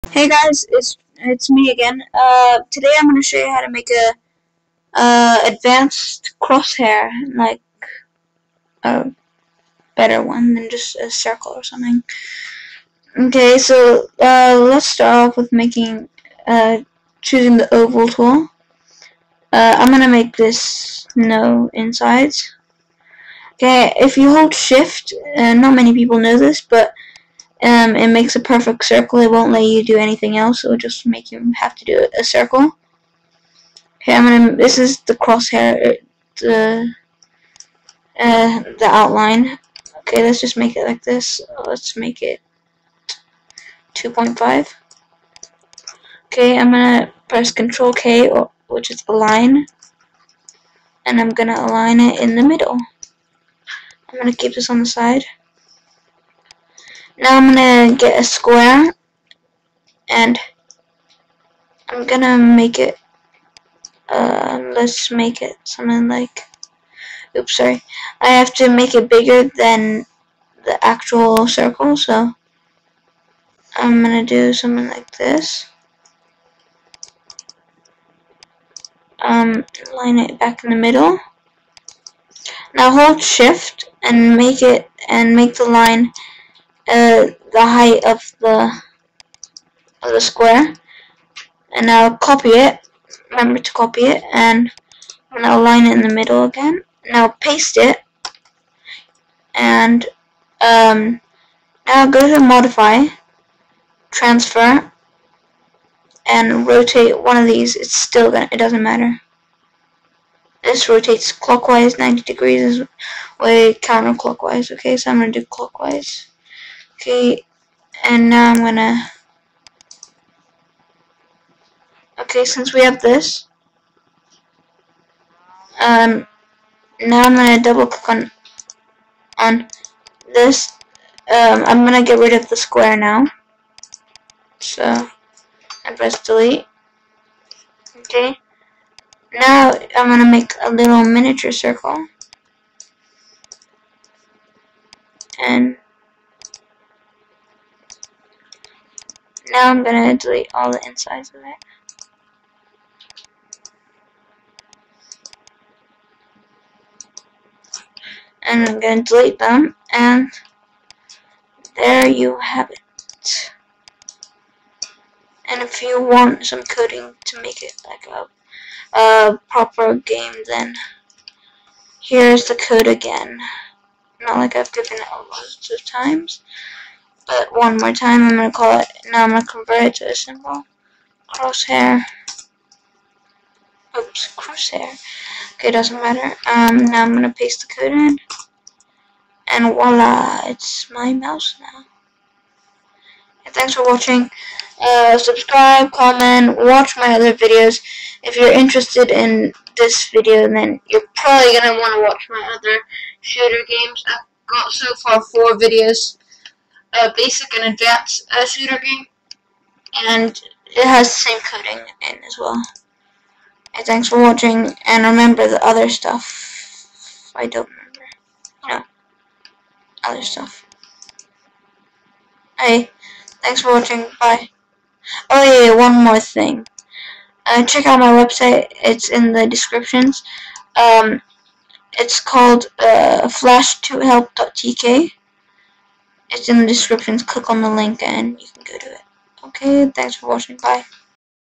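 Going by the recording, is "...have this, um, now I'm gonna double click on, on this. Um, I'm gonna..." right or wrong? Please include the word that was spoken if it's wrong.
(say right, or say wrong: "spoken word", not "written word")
right.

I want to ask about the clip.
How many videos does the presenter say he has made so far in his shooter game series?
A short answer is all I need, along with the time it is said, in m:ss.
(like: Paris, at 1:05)
4, at 3:25.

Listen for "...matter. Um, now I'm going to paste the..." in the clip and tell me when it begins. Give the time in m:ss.
3:06.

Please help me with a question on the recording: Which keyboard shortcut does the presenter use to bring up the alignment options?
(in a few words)
Control K.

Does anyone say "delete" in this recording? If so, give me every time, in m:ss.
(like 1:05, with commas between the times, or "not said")
2:16, 2:30, 2:39.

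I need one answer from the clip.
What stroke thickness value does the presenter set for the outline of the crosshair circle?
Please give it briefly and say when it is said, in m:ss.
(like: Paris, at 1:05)
2.5, at 0:43.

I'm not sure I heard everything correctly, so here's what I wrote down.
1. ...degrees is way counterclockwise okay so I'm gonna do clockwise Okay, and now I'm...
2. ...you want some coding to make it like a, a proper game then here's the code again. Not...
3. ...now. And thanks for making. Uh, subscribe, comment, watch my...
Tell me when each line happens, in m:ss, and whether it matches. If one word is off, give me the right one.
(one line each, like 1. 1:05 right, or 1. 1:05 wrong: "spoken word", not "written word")
1. 1:52 right
2. 2:45 right
3. 3:11 wrong: "watching", not "making".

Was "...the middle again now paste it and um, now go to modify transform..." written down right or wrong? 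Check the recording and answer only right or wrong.
right.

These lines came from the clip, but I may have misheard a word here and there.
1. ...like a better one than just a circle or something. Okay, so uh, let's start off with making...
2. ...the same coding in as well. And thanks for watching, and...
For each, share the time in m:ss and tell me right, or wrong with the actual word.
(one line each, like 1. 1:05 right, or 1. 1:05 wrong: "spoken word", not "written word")
1. 0:07 right
2. 3:31 right.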